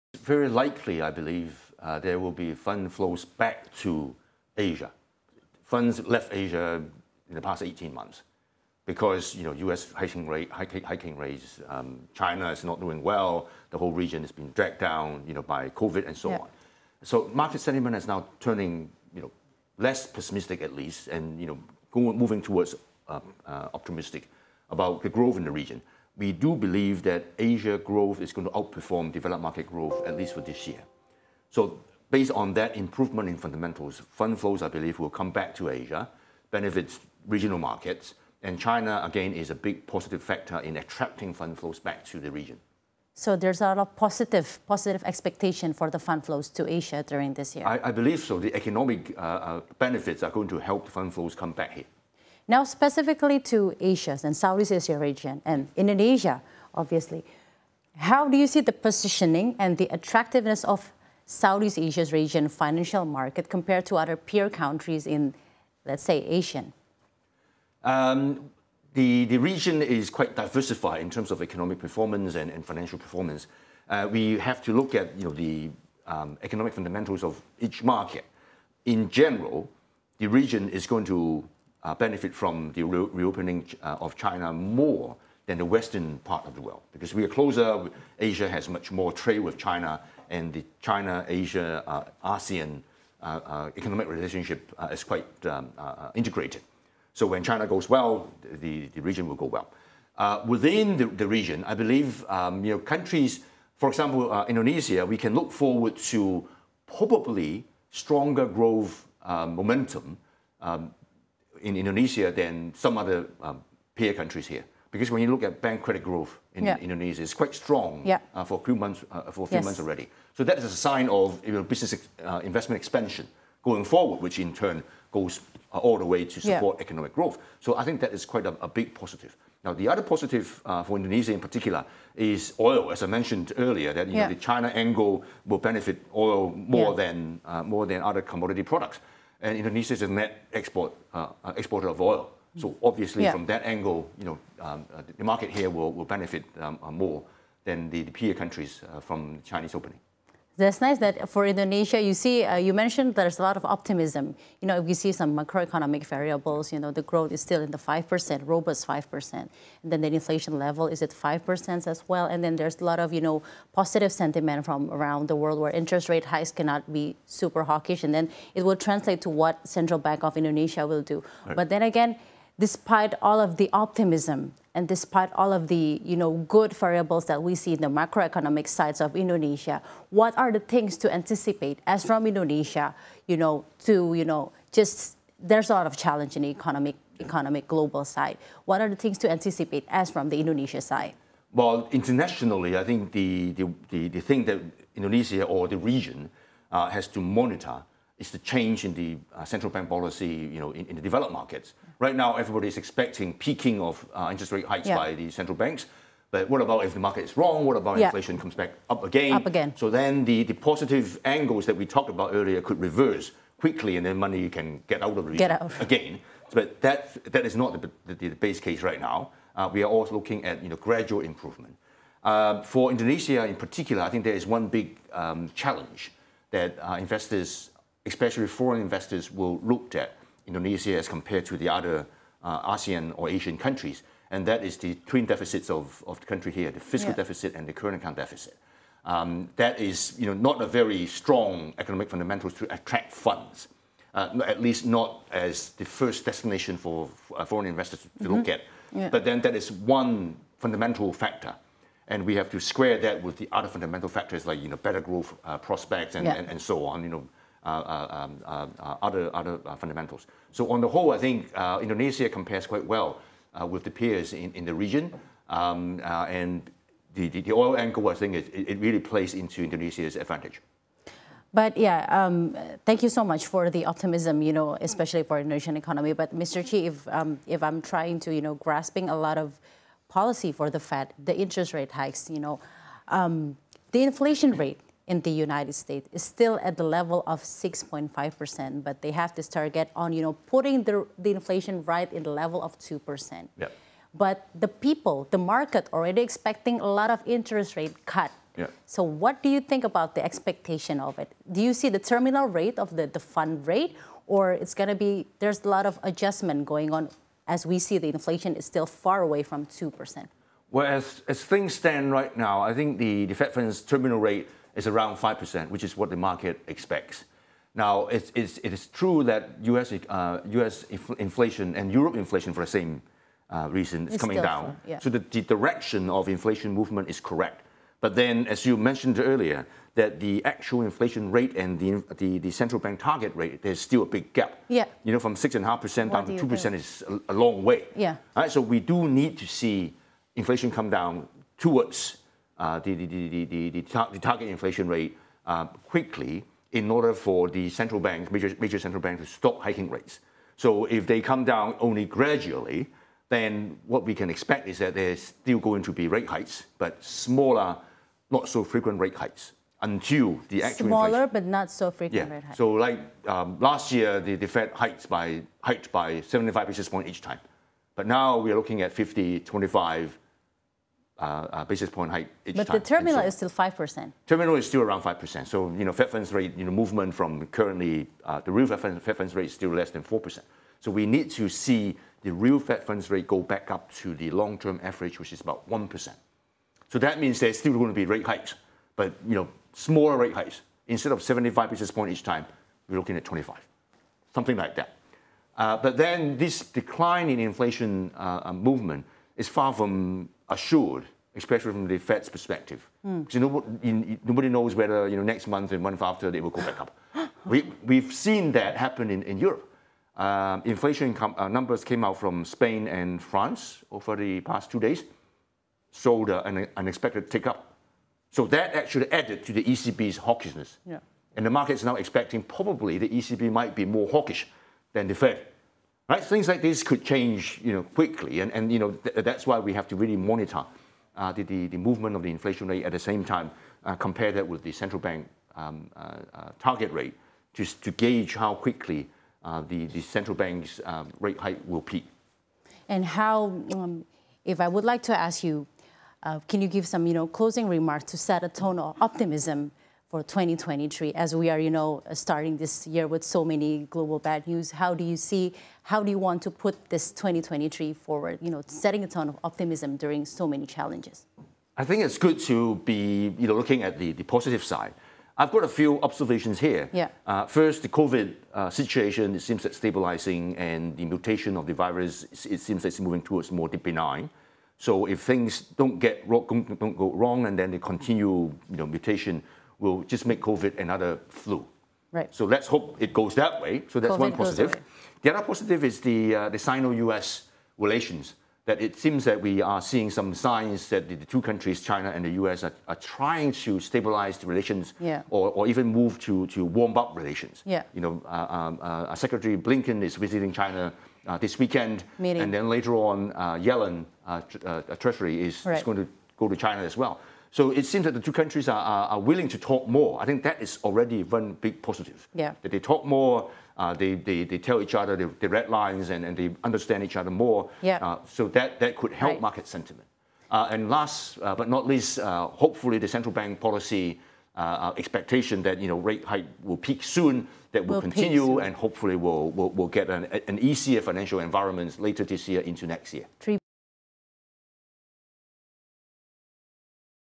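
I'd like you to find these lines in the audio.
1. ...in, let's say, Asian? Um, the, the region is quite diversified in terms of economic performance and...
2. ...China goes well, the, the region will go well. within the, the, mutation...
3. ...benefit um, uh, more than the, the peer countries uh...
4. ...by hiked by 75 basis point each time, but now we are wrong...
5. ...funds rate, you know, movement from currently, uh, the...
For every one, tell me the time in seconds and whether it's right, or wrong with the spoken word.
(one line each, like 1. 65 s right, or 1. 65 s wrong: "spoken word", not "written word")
1. 65 s right
2. 97 s wrong: "region", not "mutation"
3. 146 s right
4. 365 s wrong: "looking", not "wrong"
5. 376 s right.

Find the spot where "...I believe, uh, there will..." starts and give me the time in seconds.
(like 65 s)
1 s.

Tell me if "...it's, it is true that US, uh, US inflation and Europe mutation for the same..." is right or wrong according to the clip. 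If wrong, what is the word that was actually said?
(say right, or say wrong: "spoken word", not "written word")
wrong: "inflation", not "mutation".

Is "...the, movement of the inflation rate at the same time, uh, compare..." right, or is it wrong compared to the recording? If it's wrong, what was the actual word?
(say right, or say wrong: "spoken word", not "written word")
right.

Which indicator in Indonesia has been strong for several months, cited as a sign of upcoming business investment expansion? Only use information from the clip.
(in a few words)
Bank credit growth.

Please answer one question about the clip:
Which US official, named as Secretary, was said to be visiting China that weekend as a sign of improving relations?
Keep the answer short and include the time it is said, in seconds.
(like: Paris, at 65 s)
Blinken, at 499 s.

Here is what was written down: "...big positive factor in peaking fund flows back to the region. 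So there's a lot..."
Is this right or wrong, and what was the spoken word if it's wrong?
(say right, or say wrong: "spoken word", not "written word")
wrong: "attracting", not "peaking".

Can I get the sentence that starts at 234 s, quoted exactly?
And that is the twin deficits of, of the country here, the fiscal deficit and the current account deficit.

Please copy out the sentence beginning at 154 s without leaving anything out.
You know, if you see some macroeconomic variables, you know, the growth is still in the 5%, robust 5%.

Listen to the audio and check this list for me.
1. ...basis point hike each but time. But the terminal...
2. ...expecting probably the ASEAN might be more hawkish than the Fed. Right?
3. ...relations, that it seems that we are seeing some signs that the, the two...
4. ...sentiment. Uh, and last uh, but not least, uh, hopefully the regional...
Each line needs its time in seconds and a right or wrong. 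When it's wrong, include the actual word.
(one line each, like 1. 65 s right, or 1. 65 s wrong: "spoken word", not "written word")
1. 371 s right
2. 421 s wrong: "ECB", not "ASEAN"
3. 487 s right
4. 519 s wrong: "central", not "regional".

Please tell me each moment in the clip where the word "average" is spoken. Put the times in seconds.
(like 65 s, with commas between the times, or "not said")
384 s.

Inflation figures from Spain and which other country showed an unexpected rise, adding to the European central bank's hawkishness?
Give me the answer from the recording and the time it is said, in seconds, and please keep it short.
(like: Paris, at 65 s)
France, at 413 s.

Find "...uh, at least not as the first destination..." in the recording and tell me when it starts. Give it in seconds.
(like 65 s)
244 s.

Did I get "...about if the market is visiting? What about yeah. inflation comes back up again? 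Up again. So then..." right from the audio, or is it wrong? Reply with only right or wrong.
wrong.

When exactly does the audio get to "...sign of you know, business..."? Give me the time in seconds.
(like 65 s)
120 s.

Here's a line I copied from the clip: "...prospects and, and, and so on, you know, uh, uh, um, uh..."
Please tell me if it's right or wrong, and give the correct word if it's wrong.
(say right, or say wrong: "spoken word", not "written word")
right.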